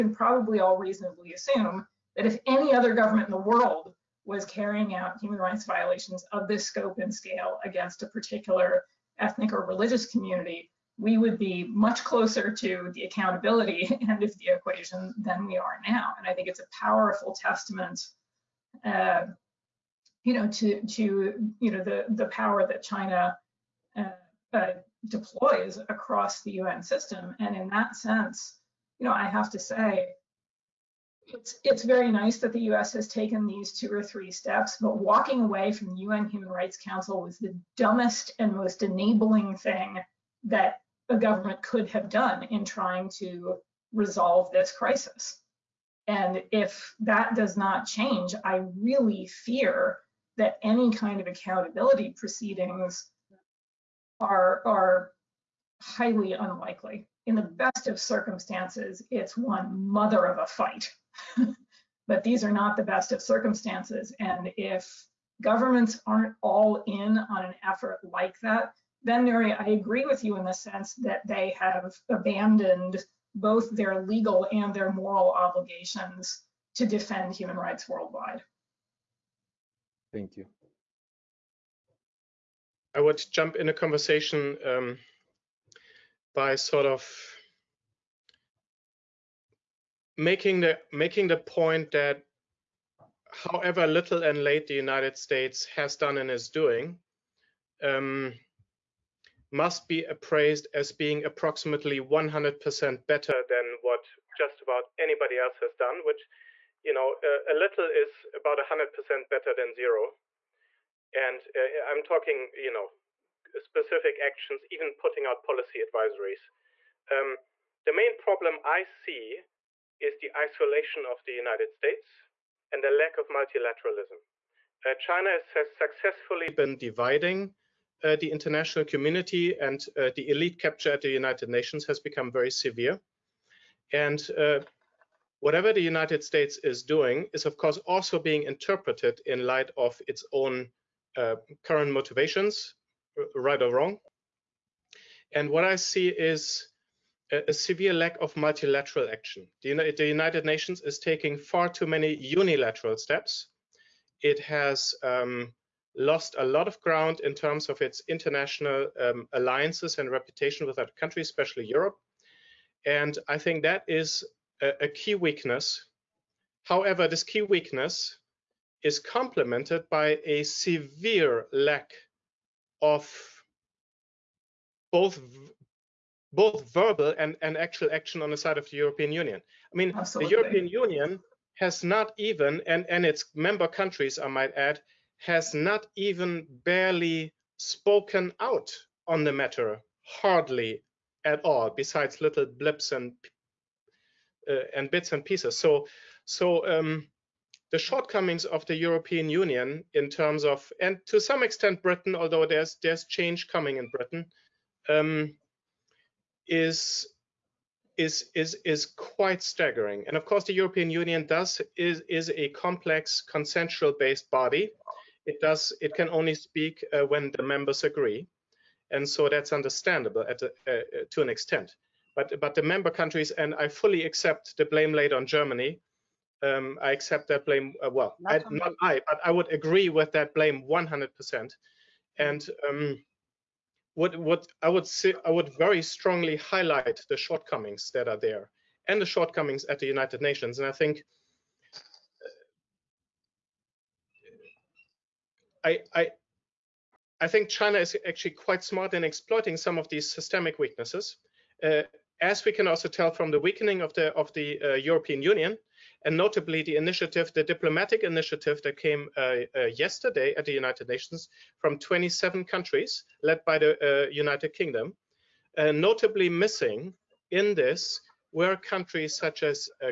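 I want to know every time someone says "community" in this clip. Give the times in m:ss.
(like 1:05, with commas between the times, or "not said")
0:10, 2:08.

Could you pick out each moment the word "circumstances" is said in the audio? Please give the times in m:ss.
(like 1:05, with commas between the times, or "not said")
0:57, 1:03.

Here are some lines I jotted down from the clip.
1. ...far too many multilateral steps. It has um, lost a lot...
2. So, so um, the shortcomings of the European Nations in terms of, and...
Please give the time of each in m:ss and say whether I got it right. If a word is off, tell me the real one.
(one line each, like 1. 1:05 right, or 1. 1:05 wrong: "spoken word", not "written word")
1. 2:31 wrong: "unilateral", not "multilateral"
2. 3:15 wrong: "Union", not "Nations".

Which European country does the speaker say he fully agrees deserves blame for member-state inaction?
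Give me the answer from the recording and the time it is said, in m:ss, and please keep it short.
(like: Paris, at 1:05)
Germany, at 3:45.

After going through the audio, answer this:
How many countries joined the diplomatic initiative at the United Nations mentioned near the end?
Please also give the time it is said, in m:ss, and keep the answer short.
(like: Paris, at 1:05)
27, at 4:21.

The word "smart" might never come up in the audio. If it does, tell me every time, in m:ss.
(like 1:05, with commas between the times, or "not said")
4:08.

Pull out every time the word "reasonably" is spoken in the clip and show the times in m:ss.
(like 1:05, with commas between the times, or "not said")
0:00.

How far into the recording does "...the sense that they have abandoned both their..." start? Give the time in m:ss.
1:10.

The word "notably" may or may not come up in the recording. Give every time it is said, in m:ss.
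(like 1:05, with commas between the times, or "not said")
4:16, 4:25.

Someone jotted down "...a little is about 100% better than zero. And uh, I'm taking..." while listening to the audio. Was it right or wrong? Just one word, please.
wrong.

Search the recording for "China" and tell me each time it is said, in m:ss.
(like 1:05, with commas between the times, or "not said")
0:22, 2:04, 4:07.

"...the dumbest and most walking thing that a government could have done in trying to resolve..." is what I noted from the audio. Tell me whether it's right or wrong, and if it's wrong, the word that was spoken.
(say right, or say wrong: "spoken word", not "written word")
wrong: "enabling", not "walking".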